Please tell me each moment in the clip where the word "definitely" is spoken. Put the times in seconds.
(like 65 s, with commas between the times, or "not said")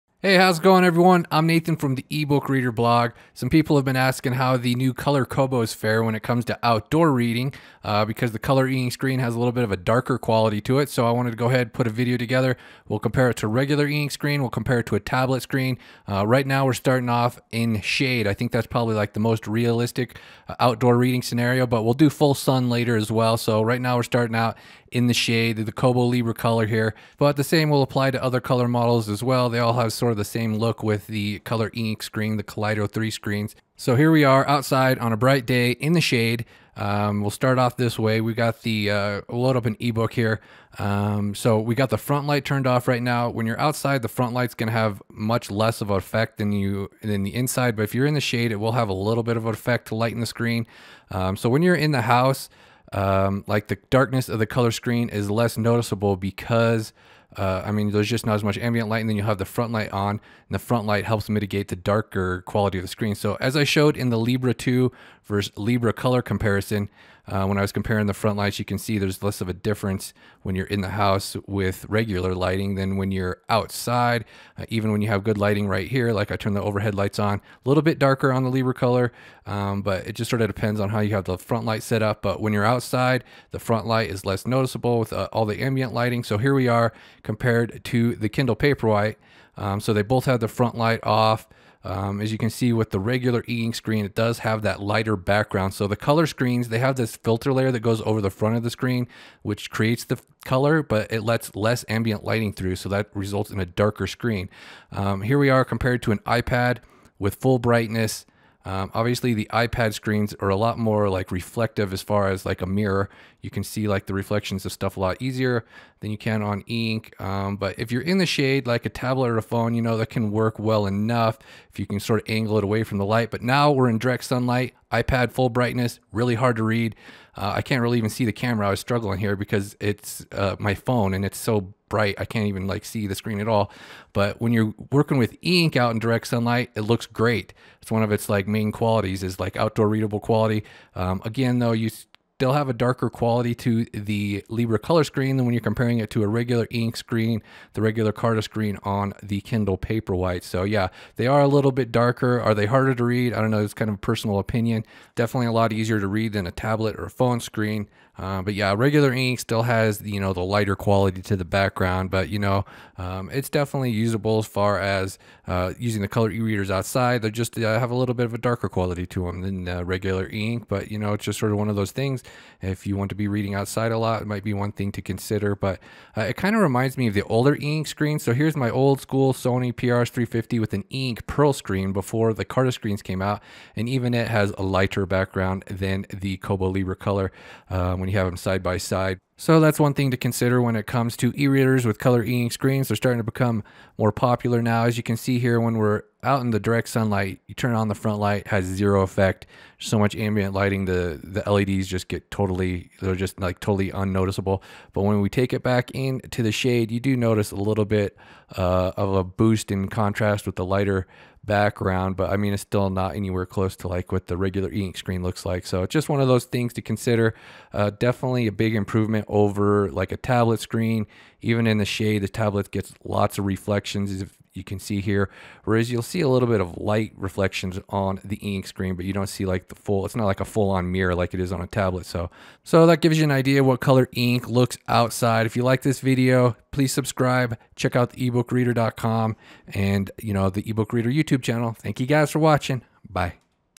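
155 s, 163 s, 217 s.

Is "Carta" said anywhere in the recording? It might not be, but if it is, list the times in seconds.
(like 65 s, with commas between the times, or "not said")
148 s, 182 s.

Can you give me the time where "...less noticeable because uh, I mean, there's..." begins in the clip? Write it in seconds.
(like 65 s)
55 s.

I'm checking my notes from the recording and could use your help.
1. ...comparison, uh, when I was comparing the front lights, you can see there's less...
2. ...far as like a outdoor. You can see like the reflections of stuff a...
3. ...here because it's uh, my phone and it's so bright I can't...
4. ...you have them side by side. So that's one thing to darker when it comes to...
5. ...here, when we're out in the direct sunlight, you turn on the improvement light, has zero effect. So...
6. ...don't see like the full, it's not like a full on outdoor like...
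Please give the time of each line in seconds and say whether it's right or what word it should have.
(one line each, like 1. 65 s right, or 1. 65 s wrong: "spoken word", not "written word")
1. 66 s right
2. 112 s wrong: "mirror", not "outdoor"
3. 129 s right
4. 188 s wrong: "consider", not "darker"
5. 195 s wrong: "front", not "improvement"
6. 229 s wrong: "mirror", not "outdoor".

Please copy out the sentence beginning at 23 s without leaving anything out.
So right now, we're starting out in the shade, the Kobo Libra color here.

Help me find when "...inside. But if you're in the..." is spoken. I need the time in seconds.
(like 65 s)
47 s.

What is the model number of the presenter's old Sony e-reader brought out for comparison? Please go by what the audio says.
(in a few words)
PRS350.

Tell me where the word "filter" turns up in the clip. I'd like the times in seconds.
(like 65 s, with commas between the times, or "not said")
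97 s.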